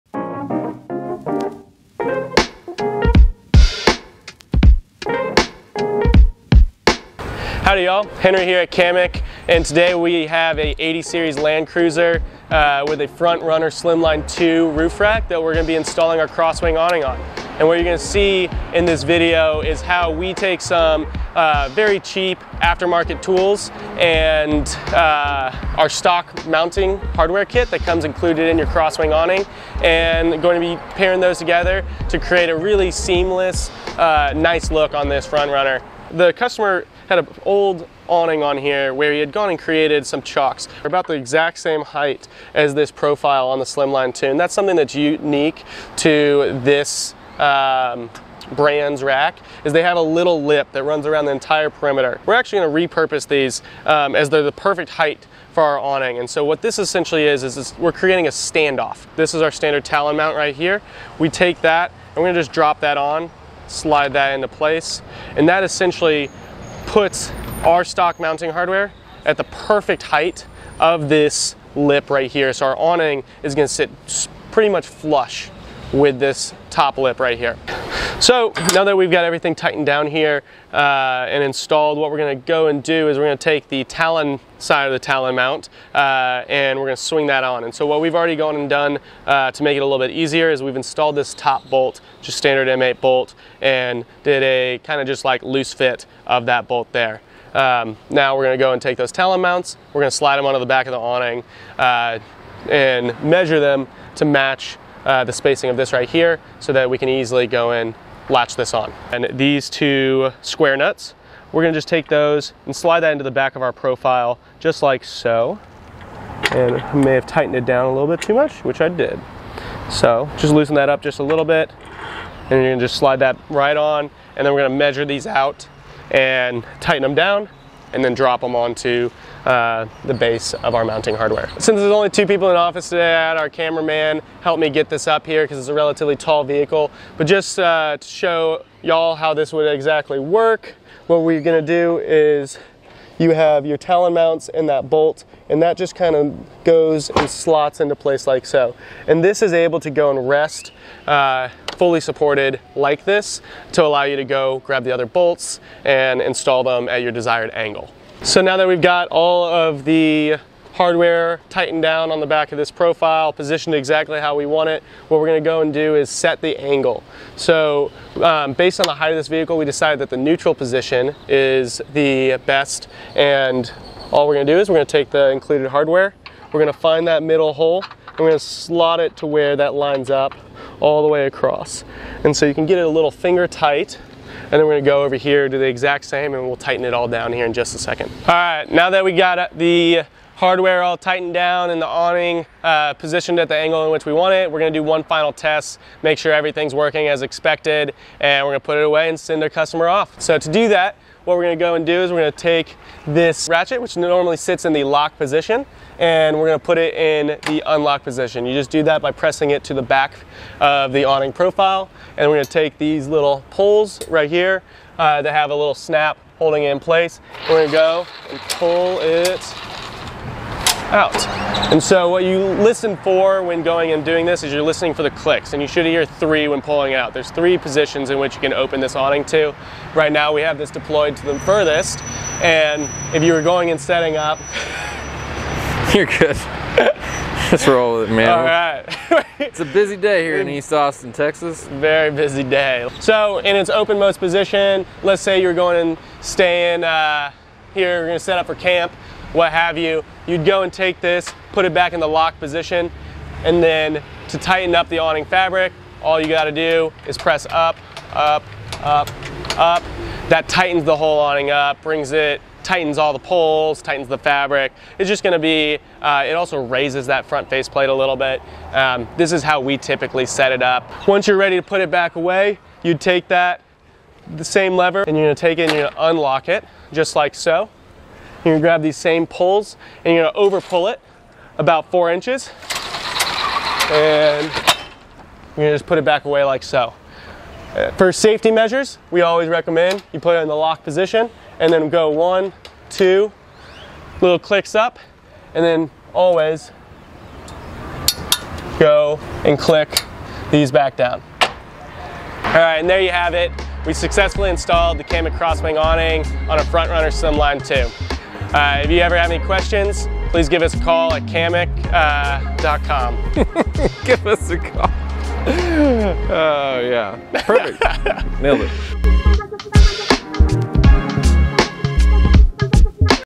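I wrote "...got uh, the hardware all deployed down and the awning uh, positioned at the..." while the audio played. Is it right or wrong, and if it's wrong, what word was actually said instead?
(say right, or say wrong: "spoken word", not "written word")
wrong: "tightened", not "deployed".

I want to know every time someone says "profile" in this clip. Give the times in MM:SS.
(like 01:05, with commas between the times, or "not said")
00:42, 01:53, 02:42, 03:31.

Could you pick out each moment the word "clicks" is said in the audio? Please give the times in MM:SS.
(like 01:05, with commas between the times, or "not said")
03:45, 04:54, 04:59.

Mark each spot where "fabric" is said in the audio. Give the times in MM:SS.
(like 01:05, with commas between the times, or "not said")
04:15, 04:24.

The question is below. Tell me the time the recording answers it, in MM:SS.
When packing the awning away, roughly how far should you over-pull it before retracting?
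04:41.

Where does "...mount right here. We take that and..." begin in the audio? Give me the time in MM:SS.
01:00.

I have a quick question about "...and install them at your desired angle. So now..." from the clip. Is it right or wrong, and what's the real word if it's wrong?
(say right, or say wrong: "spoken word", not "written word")
right.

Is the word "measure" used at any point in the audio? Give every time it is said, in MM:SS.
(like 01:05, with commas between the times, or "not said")
01:43, 02:04, 04:48.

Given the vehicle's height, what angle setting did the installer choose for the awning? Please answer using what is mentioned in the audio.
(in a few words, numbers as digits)
neutral position.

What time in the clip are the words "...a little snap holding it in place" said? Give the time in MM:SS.
03:35.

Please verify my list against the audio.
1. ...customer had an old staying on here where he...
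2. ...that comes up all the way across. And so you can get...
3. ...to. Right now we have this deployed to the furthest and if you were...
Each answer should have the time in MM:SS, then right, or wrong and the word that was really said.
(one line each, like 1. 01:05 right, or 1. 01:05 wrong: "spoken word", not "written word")
1. 00:36 wrong: "awning", not "staying"
2. 02:59 wrong: "lines", not "comes"
3. 03:49 right.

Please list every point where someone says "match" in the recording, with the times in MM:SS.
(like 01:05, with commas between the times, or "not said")
01:44.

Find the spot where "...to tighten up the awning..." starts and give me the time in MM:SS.
04:14.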